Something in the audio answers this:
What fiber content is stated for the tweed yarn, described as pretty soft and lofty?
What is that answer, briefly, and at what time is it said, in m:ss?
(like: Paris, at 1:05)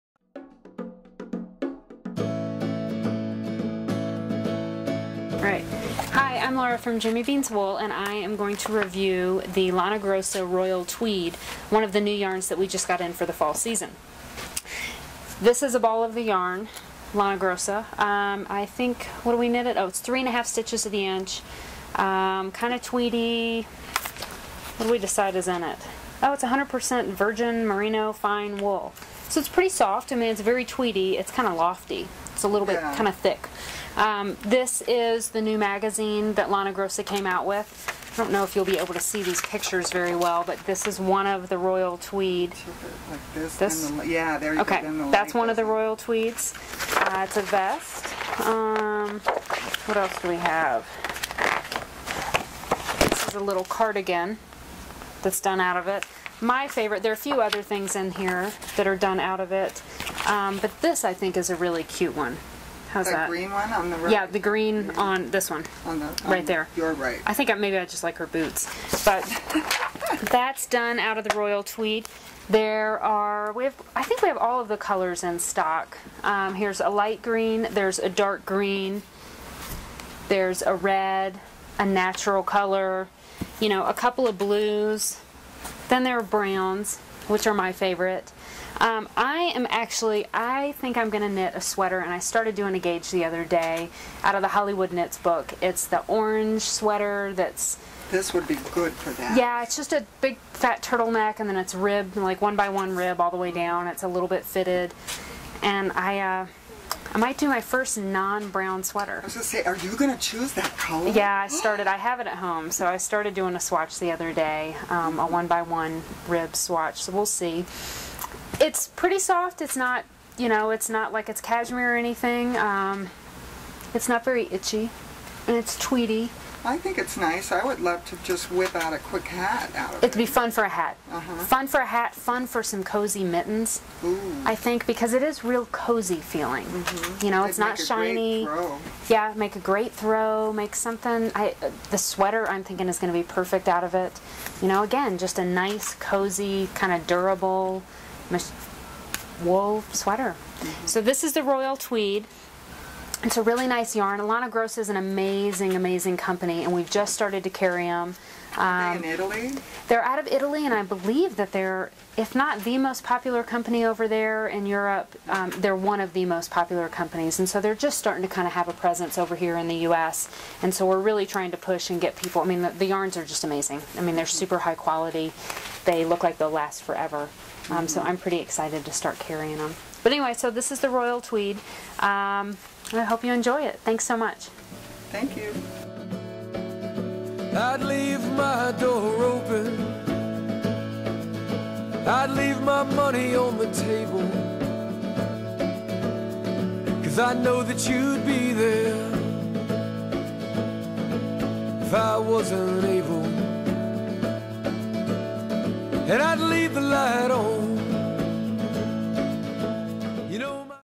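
100% virgin merino fine wool, at 0:26.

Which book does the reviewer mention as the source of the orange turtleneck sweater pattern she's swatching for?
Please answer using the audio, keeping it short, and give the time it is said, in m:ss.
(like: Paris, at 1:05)
Hollywood Knits, at 1:34.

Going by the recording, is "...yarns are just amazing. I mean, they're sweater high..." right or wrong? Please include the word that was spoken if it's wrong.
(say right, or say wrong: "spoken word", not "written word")
wrong: "super", not "sweater".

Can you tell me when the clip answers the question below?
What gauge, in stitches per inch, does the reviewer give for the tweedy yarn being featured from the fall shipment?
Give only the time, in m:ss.
0:19.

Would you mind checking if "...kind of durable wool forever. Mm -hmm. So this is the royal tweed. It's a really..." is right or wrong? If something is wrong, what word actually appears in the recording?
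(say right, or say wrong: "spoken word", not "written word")
wrong: "sweater", not "forever".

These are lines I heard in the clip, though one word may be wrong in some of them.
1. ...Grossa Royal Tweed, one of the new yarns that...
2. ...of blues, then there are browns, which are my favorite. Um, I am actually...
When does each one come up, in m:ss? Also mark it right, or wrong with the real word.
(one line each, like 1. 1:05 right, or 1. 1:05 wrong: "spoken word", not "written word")
1. 0:09 right
2. 1:24 right.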